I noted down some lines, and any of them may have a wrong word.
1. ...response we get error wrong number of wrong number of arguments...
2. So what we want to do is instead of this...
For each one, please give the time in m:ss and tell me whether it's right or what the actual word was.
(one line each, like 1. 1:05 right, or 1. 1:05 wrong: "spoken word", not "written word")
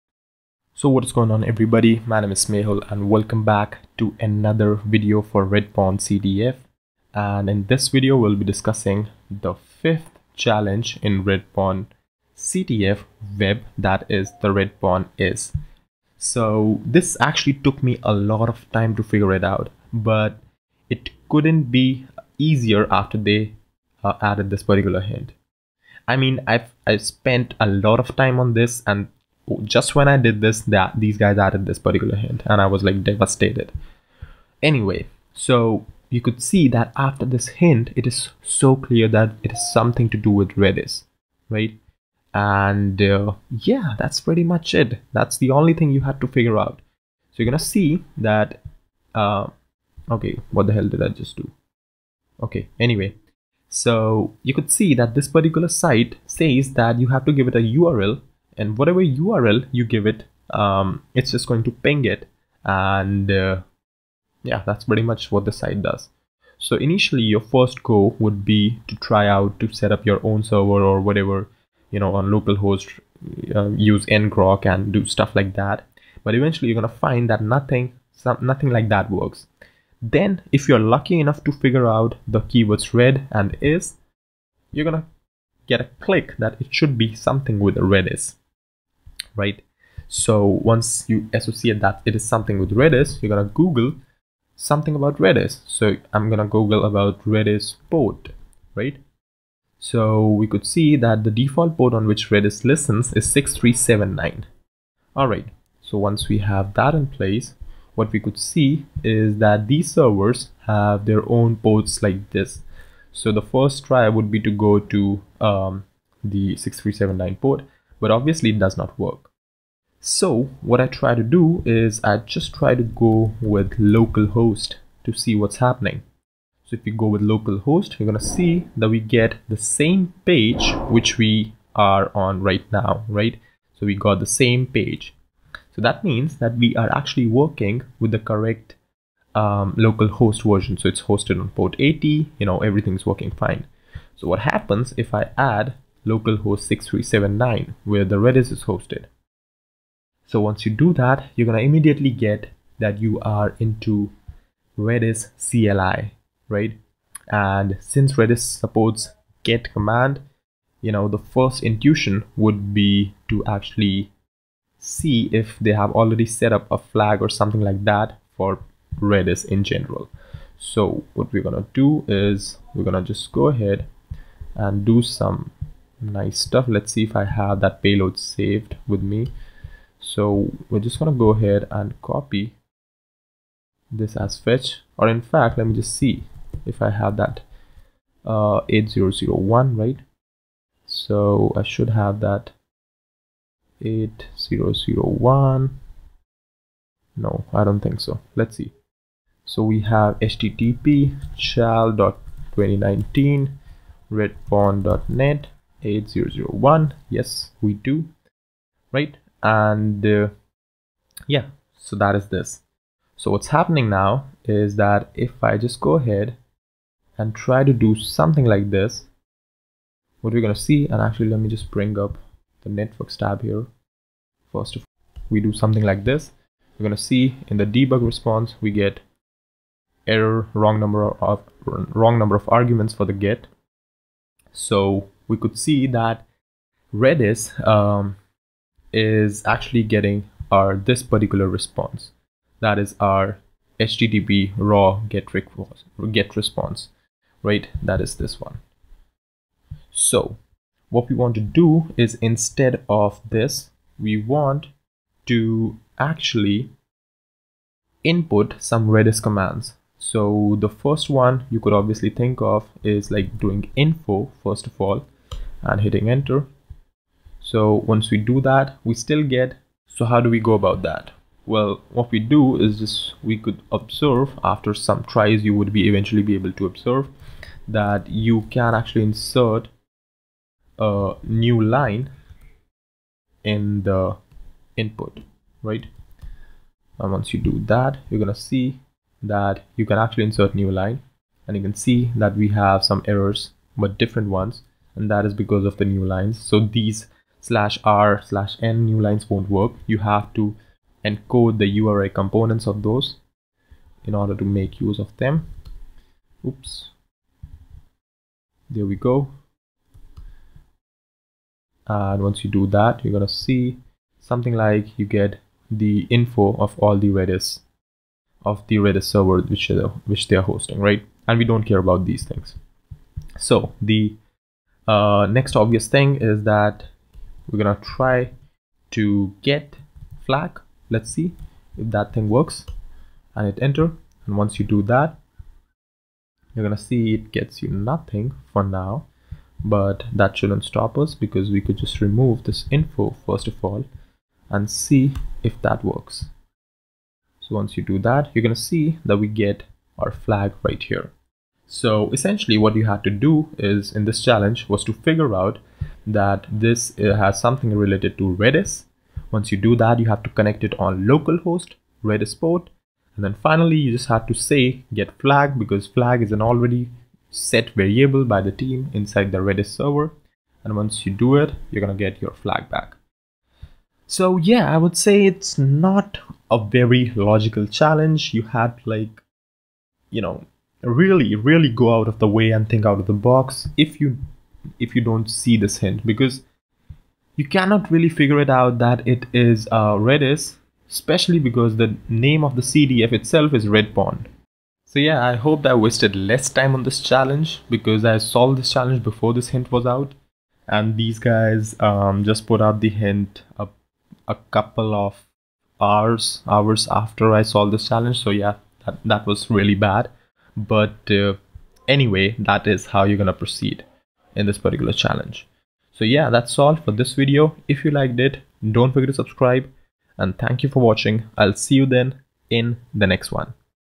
1. 3:48 right
2. 4:09 right.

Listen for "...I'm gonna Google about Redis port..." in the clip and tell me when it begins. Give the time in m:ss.
1:36.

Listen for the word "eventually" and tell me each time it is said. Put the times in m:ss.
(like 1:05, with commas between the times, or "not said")
1:16, 4:35.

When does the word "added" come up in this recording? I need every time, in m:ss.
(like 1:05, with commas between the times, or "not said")
0:24, 0:31.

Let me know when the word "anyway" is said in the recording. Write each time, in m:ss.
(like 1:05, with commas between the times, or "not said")
0:34, 0:52, 6:51.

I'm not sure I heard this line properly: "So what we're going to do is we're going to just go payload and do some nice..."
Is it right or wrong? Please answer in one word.
wrong.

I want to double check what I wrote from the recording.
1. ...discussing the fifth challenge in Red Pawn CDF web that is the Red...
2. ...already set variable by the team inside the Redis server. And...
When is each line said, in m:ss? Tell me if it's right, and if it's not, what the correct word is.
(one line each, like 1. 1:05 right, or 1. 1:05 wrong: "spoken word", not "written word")
1. 0:08 right
2. 6:06 right.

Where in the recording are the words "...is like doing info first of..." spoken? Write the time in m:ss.
4:22.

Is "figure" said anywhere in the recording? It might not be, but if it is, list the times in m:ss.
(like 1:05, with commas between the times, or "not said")
0:19, 0:46, 1:21, 5:54, 6:28.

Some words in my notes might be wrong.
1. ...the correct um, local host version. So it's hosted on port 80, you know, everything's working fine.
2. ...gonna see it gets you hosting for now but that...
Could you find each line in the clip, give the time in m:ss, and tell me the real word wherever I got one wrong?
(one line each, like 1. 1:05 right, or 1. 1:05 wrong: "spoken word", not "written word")
1. 2:18 right
2. 5:36 wrong: "nothing", not "hosting".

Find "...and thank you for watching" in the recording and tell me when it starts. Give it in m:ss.
7:00.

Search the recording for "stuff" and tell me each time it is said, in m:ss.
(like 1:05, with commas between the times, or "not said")
1:15, 2:56.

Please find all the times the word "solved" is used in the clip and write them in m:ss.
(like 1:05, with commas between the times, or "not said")
6:38, 6:47.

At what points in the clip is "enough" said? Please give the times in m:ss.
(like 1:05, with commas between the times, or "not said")
1:21.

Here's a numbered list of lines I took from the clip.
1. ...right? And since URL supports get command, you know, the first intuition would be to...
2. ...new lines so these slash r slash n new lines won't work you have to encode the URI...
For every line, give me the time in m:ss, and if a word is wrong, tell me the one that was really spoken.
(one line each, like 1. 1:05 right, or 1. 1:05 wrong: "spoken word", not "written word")
1. 2:36 wrong: "Redis", not "URL"
2. 4:55 right.